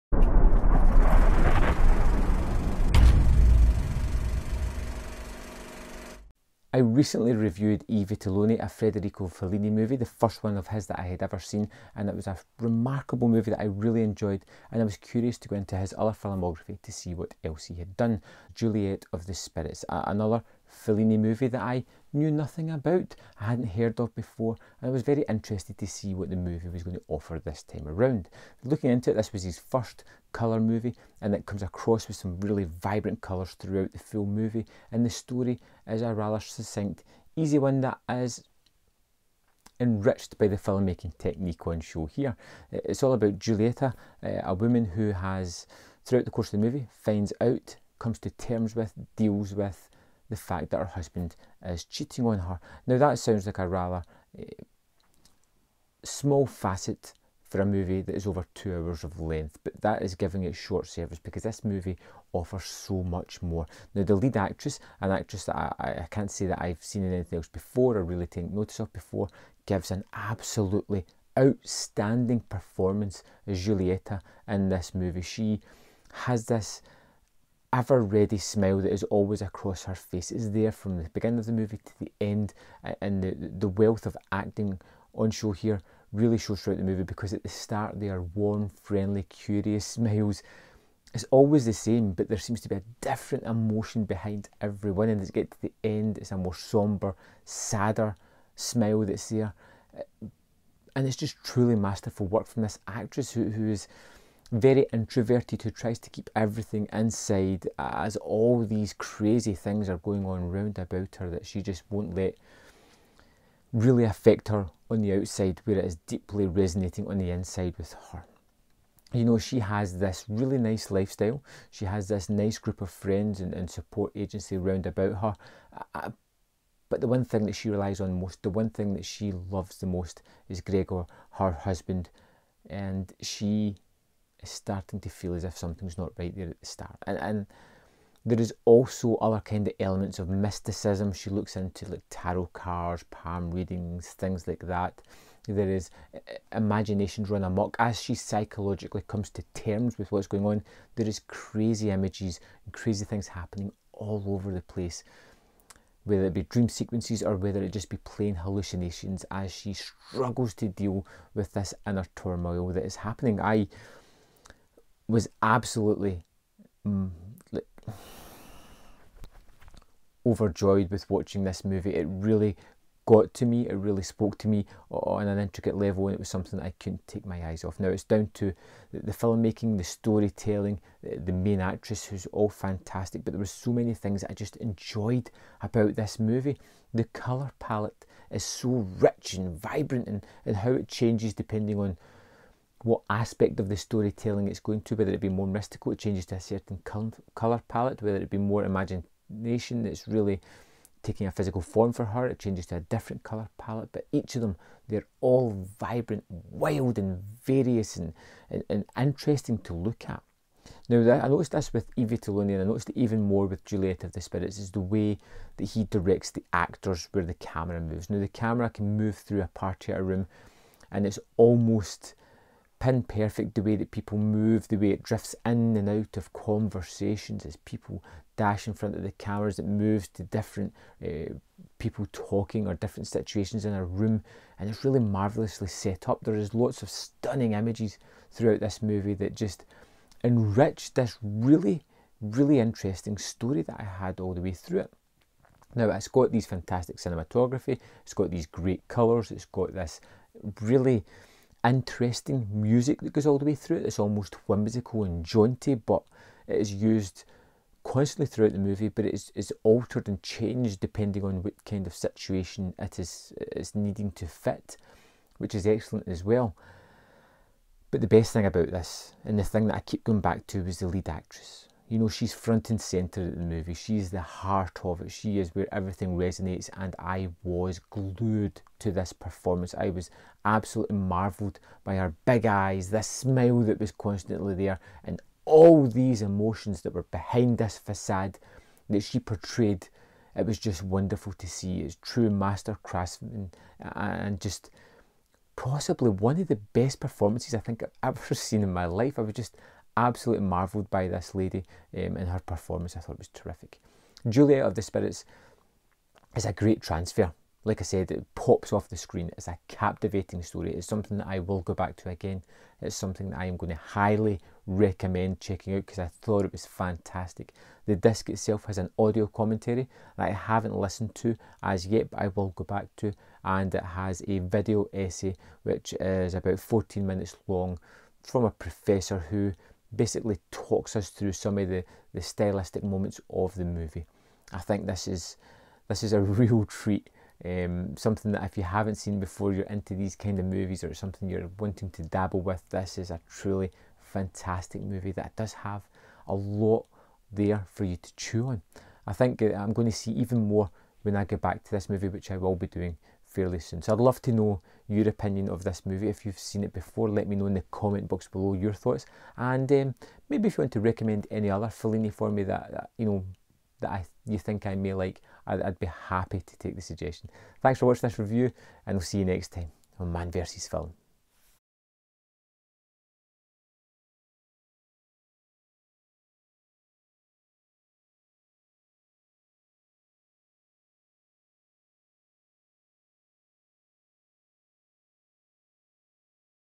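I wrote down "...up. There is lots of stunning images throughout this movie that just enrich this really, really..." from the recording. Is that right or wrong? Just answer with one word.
right.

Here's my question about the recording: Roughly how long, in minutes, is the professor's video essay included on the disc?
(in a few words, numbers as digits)
14.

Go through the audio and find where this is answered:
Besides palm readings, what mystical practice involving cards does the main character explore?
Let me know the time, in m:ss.
2:22.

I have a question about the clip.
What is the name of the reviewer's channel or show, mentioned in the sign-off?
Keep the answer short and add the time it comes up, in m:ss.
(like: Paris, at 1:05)
Man vs. Film, at 6:10.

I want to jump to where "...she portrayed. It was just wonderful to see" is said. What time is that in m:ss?
4:49.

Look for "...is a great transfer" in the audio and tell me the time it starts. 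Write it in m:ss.
5:06.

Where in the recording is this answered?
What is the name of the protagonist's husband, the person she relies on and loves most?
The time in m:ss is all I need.
2:10.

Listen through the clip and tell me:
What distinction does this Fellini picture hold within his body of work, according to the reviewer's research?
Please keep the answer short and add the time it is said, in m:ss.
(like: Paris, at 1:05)
His first colour movie, at 0:29.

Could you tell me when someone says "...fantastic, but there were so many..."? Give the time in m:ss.
3:02.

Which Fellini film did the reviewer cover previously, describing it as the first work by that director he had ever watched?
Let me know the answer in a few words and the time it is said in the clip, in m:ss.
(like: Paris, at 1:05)
I Vitelloni, at 0:07.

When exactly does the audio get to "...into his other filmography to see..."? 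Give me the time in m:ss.
0:15.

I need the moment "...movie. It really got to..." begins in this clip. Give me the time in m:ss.
2:51.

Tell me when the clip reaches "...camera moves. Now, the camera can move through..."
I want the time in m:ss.
3:37.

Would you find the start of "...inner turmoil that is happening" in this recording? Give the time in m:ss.
2:41.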